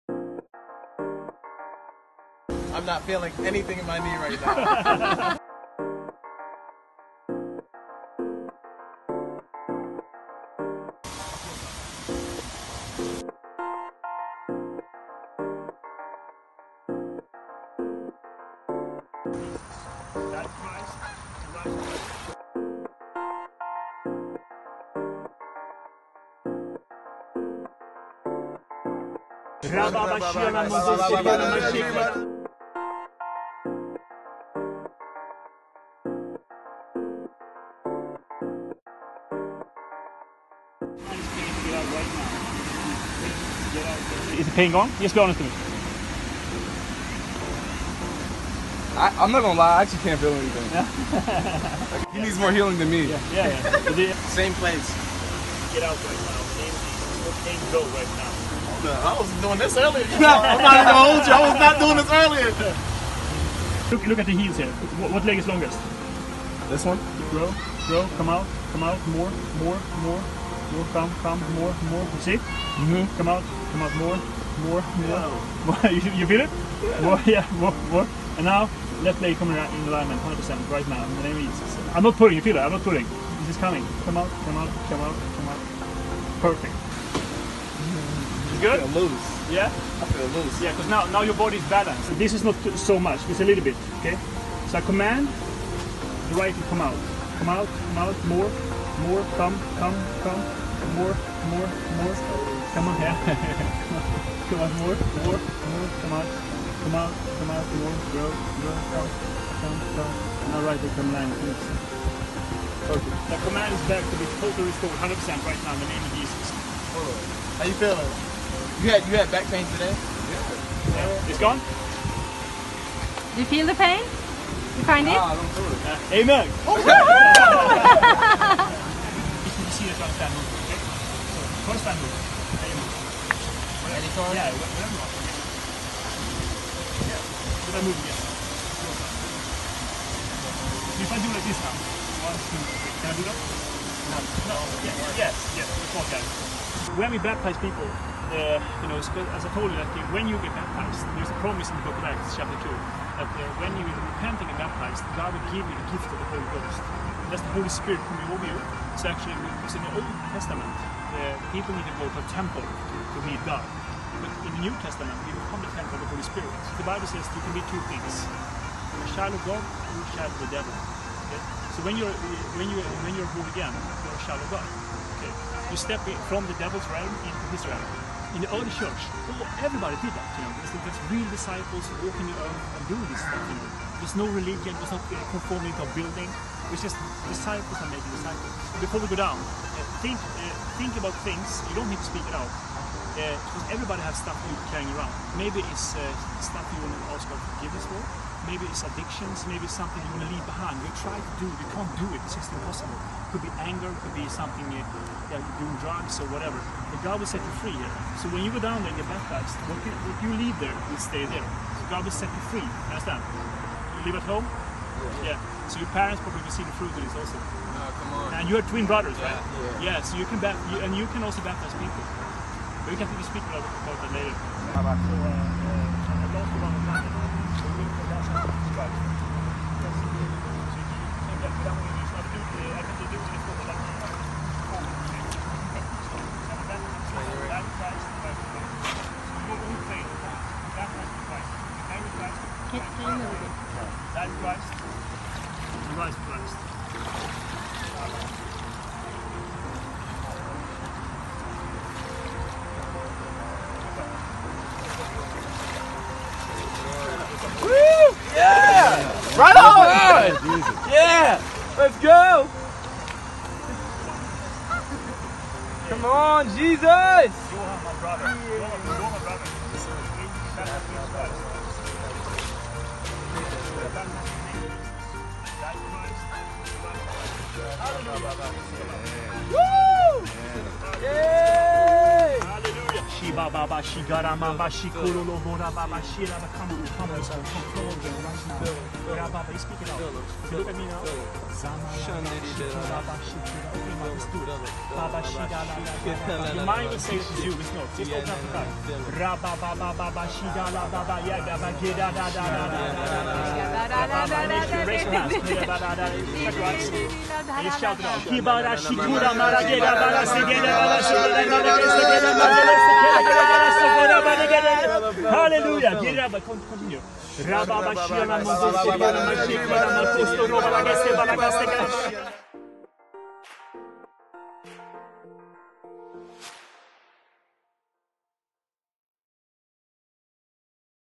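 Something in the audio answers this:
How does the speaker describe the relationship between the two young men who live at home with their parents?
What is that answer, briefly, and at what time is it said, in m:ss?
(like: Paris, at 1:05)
twin brothers, at 3:38.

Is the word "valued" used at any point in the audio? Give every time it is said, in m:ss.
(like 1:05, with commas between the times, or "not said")
not said.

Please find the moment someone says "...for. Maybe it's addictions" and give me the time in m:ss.
3:17.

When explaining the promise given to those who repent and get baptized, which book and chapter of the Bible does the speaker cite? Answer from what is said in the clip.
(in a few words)
Acts chapter 2.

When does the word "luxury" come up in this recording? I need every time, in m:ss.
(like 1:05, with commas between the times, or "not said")
not said.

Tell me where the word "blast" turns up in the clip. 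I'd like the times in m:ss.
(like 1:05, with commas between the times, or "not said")
4:06.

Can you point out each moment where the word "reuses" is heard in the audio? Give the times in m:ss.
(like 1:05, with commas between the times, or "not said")
not said.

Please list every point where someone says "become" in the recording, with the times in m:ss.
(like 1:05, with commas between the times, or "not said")
2:45.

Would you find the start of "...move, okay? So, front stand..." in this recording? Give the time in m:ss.
2:10.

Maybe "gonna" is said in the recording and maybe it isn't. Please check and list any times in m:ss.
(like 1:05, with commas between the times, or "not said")
0:49, 1:00.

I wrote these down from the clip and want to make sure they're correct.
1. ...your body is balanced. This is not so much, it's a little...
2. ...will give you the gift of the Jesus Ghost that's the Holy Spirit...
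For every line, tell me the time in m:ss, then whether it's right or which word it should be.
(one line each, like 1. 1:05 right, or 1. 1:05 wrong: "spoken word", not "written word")
1. 1:31 right
2. 2:35 wrong: "Holy", not "Jesus".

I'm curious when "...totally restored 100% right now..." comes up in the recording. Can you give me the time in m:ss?
1:54.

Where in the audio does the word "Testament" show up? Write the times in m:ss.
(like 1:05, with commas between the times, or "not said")
2:40, 2:44.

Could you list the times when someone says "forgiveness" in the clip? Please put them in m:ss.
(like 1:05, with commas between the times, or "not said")
3:17.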